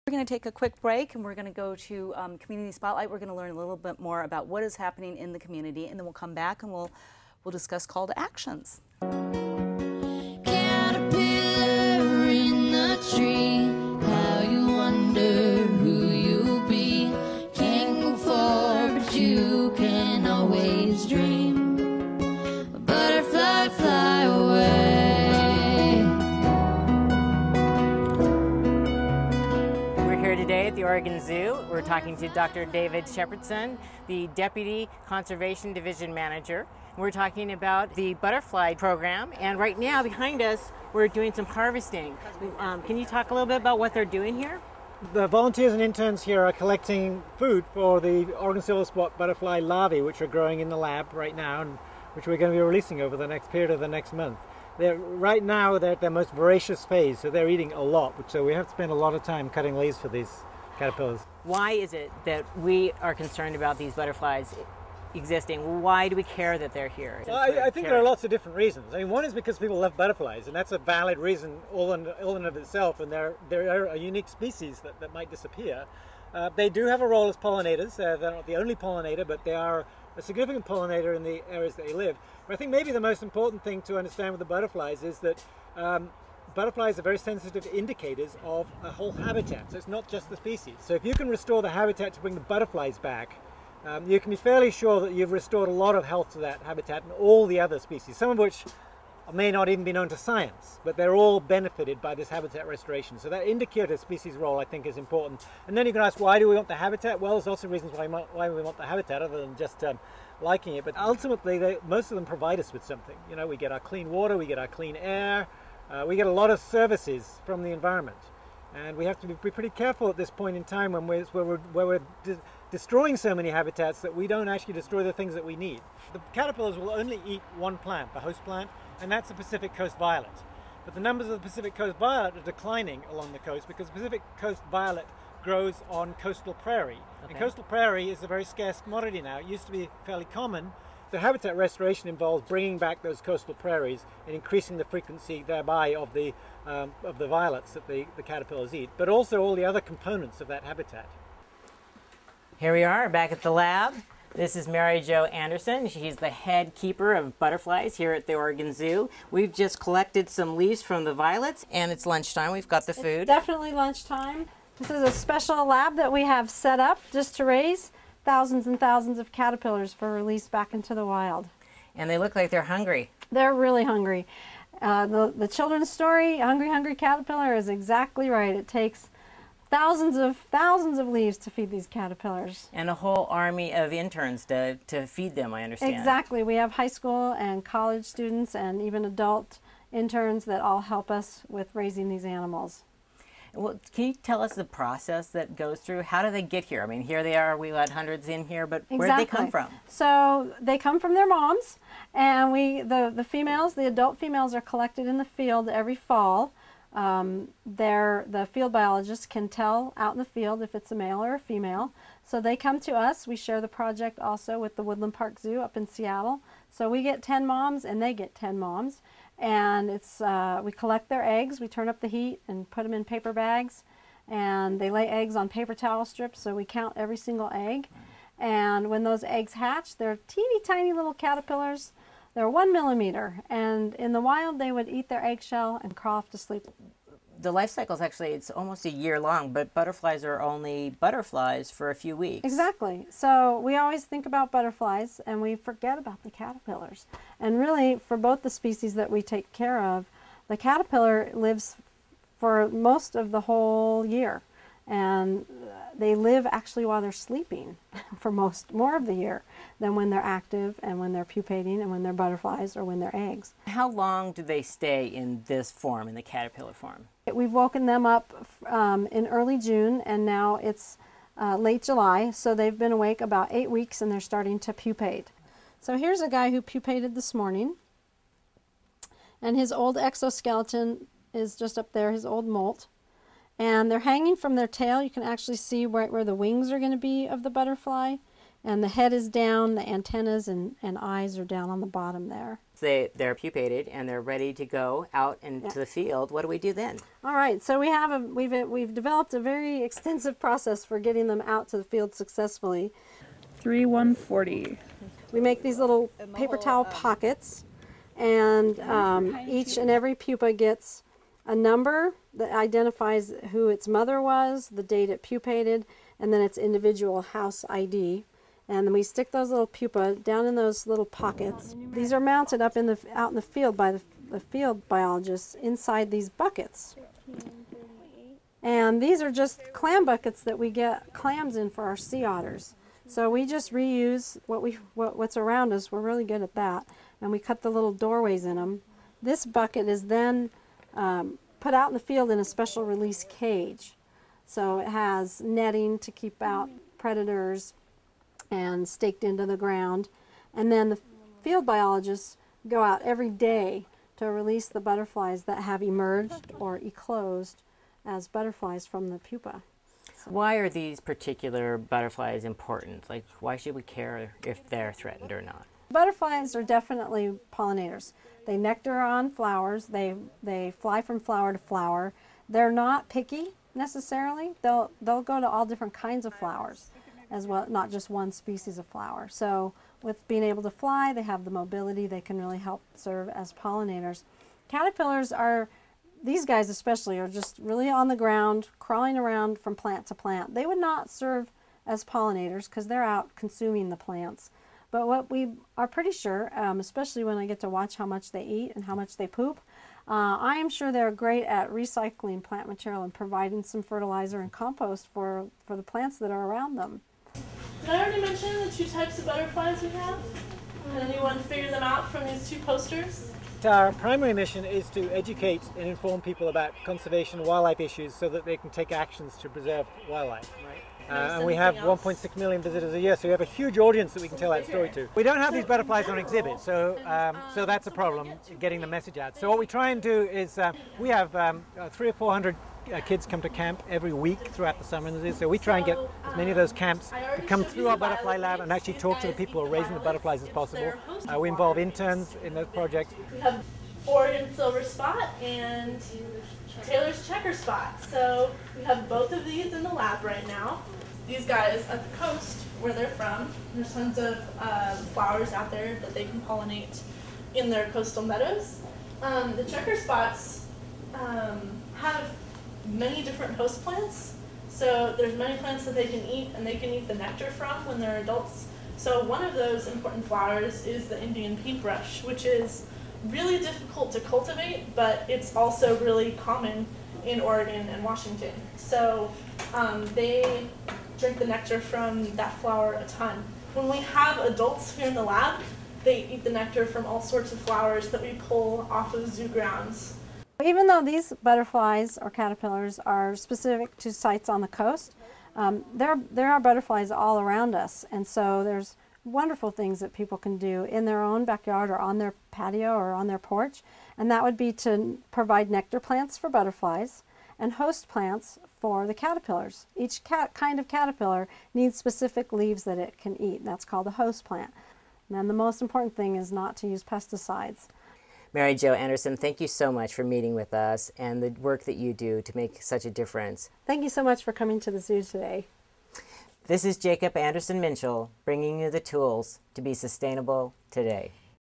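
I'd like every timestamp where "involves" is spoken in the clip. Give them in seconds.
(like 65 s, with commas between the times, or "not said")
142 s, 441 s.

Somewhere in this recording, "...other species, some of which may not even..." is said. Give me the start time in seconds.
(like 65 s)
97 s.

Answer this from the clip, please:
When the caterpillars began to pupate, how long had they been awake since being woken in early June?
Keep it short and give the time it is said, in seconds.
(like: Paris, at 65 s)
About eight weeks, at 273 s.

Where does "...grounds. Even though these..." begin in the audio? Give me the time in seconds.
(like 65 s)
489 s.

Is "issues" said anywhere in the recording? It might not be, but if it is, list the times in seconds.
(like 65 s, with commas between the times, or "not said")
417 s.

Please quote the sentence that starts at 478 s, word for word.
So um, they drink the nectar from that flower a ton.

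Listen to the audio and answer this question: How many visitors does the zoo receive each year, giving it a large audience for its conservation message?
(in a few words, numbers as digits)
1.6 million.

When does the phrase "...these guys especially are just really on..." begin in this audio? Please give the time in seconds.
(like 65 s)
386 s.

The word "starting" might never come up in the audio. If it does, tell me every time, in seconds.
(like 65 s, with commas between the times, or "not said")
274 s.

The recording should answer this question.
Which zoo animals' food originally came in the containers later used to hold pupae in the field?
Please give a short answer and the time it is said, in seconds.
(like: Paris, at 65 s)
Sea otters, at 331 s.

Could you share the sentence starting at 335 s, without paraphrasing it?
We're really good at that, and we cut the little doorways in them.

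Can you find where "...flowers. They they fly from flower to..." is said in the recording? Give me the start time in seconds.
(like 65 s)
369 s.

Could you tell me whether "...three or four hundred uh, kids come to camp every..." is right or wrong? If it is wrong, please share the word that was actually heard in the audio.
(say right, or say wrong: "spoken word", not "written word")
right.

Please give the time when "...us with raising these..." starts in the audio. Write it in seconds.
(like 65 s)
191 s.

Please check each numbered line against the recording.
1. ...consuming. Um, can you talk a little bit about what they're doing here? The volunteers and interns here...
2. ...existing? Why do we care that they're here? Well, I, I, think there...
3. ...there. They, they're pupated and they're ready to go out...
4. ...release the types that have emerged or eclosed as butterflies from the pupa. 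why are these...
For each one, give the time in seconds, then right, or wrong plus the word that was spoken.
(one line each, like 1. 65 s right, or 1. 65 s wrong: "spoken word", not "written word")
1. 41 s wrong: "harvesting", not "consuming"
2. 65 s right
3. 292 s right
4. 354 s wrong: "butterflies", not "types".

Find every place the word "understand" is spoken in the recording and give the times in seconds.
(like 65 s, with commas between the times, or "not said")
83 s, 185 s.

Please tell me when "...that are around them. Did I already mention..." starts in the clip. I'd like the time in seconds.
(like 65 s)
406 s.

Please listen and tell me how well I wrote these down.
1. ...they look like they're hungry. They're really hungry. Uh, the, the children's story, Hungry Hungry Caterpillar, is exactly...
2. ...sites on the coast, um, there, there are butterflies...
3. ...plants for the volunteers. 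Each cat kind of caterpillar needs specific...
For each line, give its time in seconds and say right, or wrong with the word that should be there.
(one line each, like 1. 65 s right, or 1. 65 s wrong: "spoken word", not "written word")
1. 172 s right
2. 494 s right
3. 508 s wrong: "caterpillars", not "volunteers".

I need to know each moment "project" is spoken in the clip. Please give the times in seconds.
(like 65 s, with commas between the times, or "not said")
213 s, 442 s.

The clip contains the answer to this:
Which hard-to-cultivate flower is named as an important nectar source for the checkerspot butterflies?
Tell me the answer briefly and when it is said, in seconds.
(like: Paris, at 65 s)
Indian paintbrush, at 471 s.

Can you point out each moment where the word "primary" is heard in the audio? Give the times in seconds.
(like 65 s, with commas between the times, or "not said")
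413 s.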